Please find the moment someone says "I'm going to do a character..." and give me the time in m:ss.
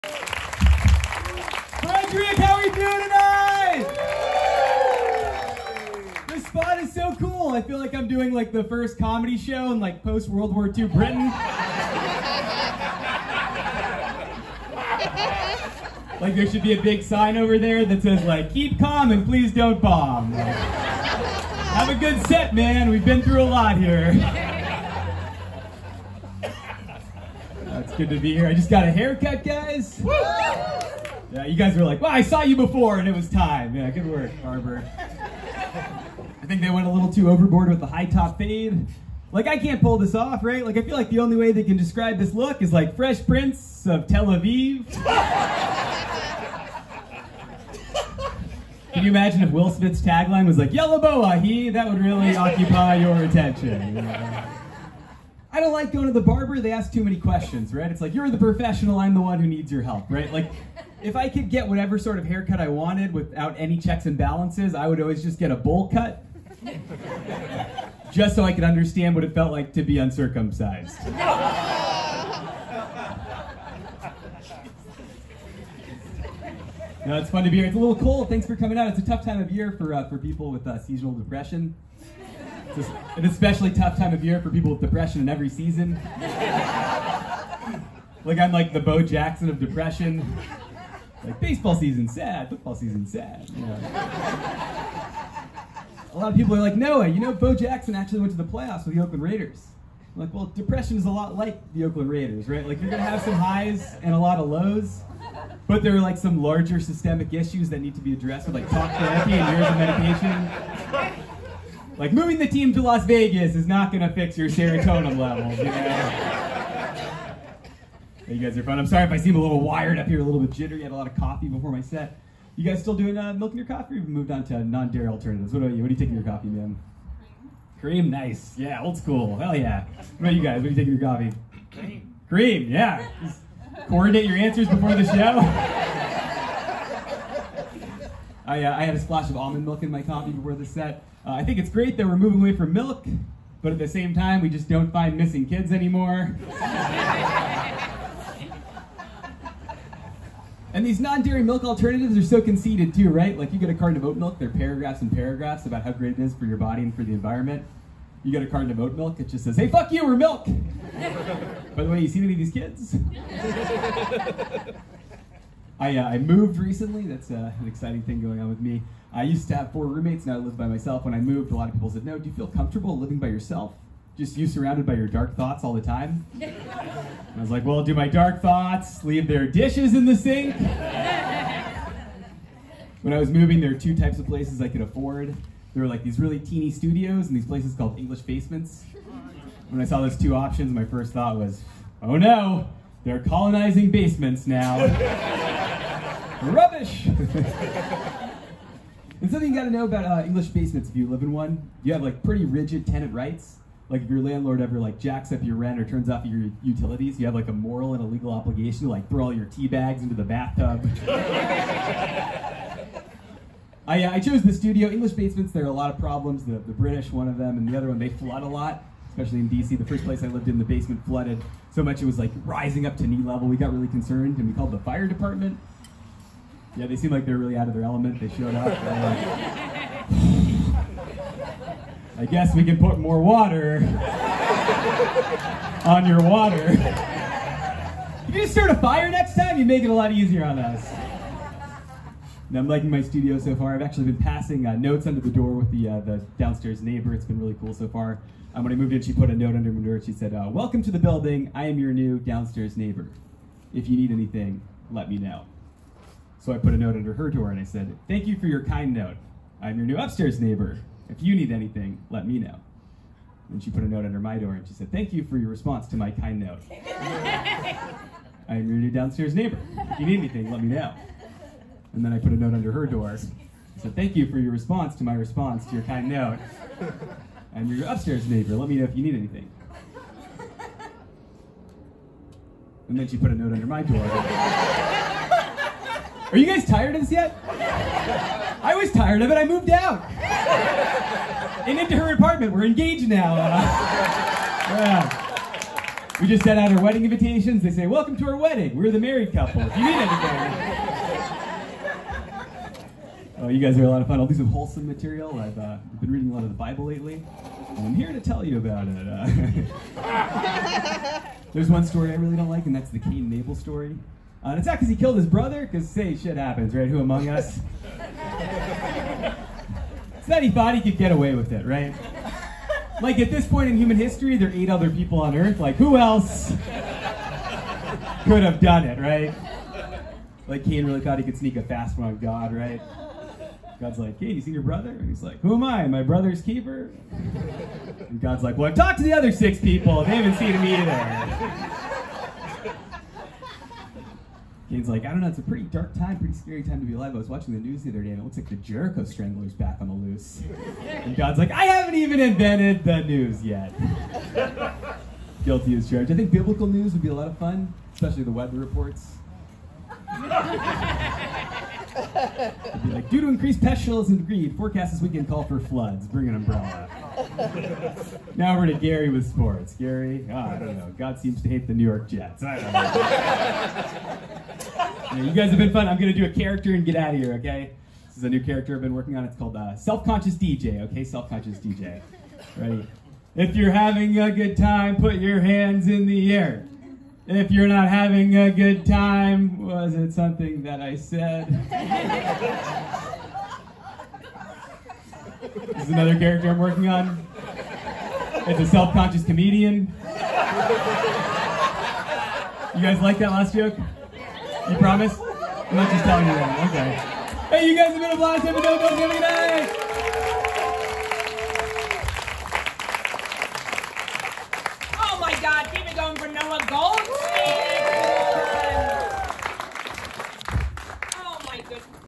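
6:15.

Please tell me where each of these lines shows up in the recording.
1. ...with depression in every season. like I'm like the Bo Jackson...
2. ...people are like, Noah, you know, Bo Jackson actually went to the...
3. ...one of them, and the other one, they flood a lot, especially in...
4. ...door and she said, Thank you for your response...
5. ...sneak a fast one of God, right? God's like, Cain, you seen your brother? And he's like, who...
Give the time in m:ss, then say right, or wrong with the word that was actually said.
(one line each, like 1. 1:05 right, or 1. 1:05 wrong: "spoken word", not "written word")
1. 1:24 right
2. 1:36 right
3. 3:37 right
4. 4:24 right
5. 5:31 right.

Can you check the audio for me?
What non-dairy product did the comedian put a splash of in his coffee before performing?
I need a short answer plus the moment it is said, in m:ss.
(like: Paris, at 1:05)
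almond milk, at 2:19.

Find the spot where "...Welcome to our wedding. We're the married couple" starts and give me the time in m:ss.
4:57.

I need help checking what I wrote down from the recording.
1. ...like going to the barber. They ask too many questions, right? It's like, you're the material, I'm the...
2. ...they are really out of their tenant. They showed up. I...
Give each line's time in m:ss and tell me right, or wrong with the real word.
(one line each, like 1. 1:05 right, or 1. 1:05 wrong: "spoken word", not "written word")
1. 0:55 wrong: "professional", not "material"
2. 3:47 wrong: "element", not "tenant".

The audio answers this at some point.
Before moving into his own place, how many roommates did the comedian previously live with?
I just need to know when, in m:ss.
2:49.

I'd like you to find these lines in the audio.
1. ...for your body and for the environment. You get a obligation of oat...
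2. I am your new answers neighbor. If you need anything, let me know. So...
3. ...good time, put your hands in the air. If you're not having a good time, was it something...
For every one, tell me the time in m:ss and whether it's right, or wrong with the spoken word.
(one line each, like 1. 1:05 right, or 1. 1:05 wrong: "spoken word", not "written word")
1. 2:36 wrong: "carton", not "obligation"
2. 4:11 wrong: "downstairs", not "answers"
3. 6:24 right.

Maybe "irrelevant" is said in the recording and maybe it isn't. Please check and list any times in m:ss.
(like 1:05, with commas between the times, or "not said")
not said.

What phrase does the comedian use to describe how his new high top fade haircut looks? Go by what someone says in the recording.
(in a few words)
Fresh Prince of Tel Aviv.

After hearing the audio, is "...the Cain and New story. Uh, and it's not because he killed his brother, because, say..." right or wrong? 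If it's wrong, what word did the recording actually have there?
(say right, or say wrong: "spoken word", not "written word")
wrong: "Abel", not "New".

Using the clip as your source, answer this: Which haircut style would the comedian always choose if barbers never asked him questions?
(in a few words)
bowl cut.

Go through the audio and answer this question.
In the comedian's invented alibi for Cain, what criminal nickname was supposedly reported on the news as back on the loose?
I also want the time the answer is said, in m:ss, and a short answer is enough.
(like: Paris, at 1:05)
Jericho Strangler, at 5:48.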